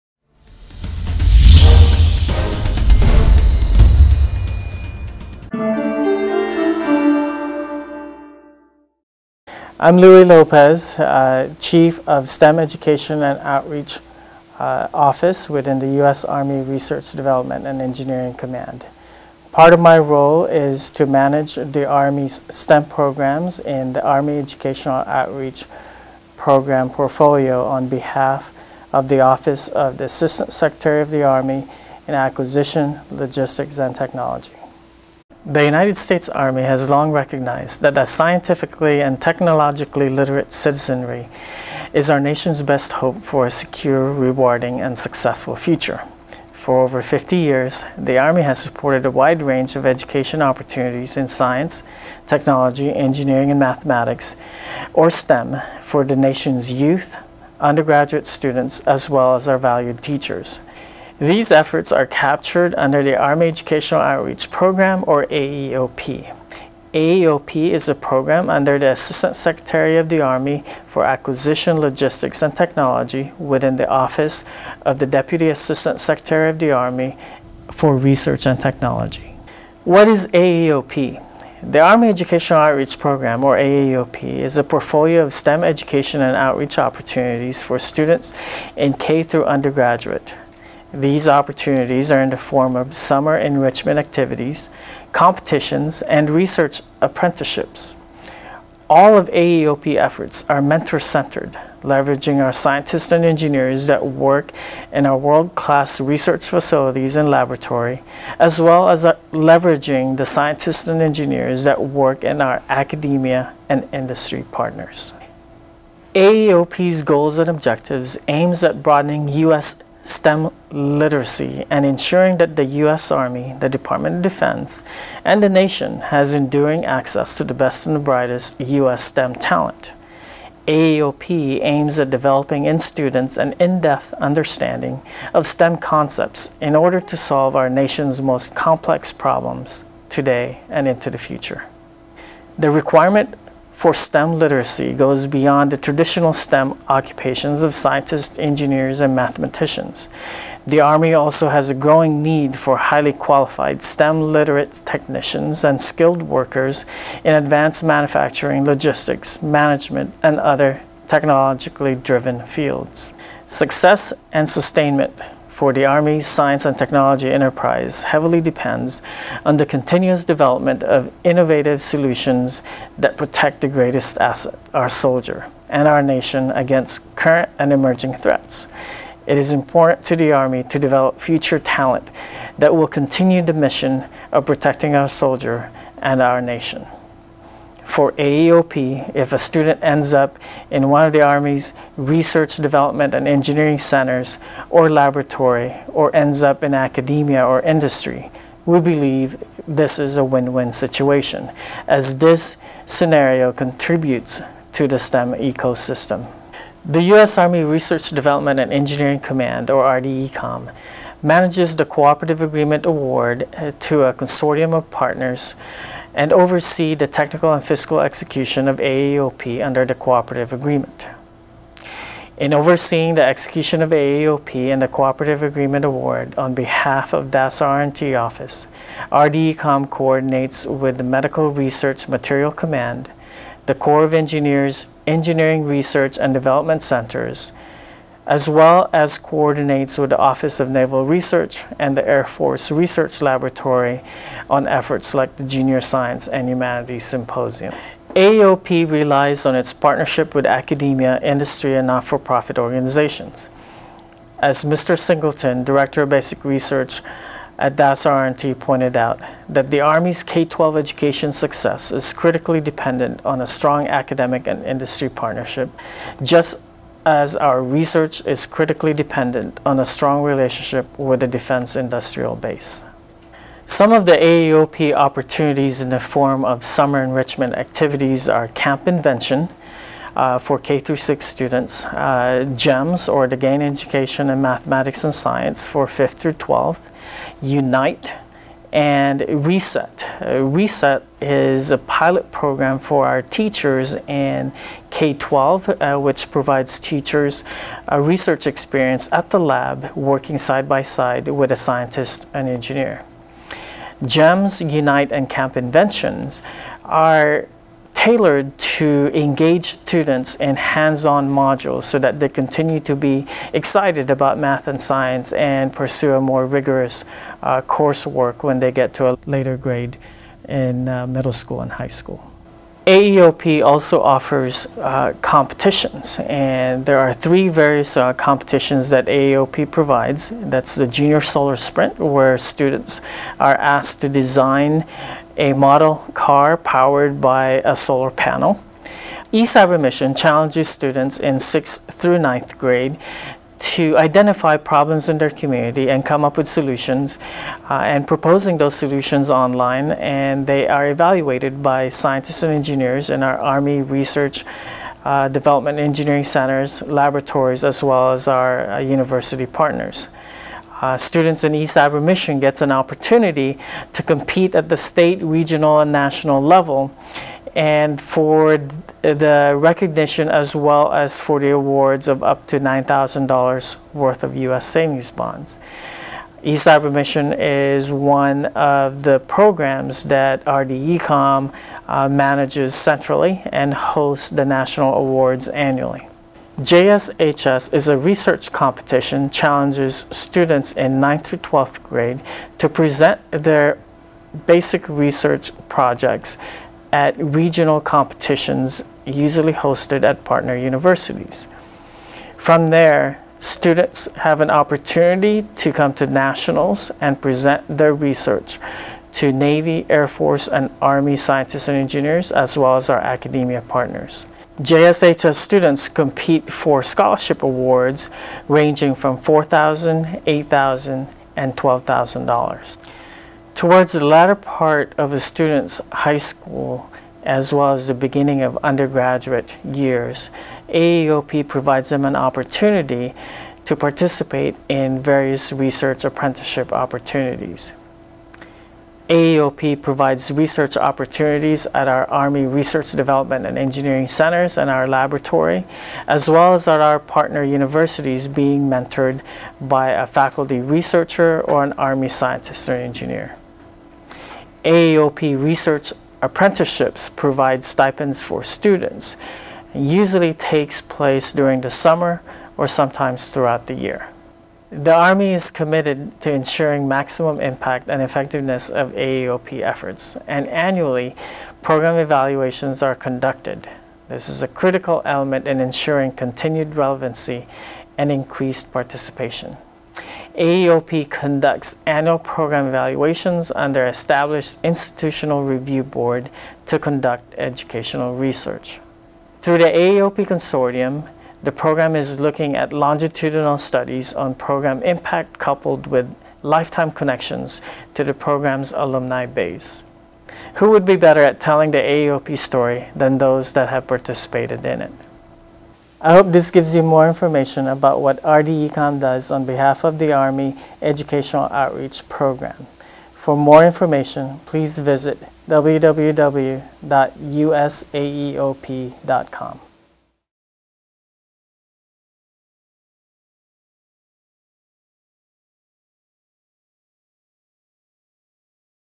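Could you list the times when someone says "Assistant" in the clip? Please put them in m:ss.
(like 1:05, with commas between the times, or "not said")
0:30, 1:08, 1:15.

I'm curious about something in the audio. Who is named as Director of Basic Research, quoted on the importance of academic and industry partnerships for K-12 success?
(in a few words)
Mr. Singleton.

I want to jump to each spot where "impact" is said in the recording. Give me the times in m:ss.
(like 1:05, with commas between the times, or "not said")
7:47, 8:14.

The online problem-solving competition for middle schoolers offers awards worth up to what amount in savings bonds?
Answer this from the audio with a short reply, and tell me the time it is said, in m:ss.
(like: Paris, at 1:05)
$9,000, at 6:12.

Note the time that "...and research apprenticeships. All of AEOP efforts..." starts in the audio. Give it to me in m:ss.
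1:36.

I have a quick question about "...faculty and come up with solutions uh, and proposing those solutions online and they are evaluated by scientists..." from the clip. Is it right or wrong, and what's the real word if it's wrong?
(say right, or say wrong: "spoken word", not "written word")
wrong: "community", not "faculty".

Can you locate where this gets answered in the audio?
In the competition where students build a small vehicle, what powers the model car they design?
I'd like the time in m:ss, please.
5:37.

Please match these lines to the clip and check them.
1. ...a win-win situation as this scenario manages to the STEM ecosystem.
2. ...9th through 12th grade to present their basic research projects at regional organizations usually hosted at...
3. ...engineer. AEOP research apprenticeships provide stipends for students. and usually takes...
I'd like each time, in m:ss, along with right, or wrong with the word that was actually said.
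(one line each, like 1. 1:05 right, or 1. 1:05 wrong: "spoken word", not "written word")
1. 3:20 wrong: "contributes", not "manages"
2. 6:31 wrong: "competitions", not "organizations"
3. 7:32 right.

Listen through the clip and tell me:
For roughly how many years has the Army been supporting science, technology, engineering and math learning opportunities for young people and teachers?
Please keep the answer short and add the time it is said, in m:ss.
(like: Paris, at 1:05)
over 50 years, at 0:46.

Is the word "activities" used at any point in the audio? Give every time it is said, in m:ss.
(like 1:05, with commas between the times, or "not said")
1:33, 4:37.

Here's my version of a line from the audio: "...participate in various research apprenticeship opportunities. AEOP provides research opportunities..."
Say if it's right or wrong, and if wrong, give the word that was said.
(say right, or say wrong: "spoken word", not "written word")
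right.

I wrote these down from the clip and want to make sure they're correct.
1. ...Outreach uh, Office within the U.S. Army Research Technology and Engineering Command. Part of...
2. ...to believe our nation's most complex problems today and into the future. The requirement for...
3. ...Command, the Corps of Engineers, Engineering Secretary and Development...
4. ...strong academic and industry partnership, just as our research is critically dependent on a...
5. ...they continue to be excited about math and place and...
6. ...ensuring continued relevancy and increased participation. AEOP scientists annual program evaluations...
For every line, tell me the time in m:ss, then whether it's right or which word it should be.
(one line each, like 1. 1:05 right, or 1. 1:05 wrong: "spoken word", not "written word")
1. 0:13 wrong: "Development", not "Technology"
2. 2:17 wrong: "solve", not "believe"
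3. 3:52 wrong: "Research", not "Secretary"
4. 4:23 right
5. 5:12 wrong: "science", not "place"
6. 7:55 wrong: "conducts", not "scientists".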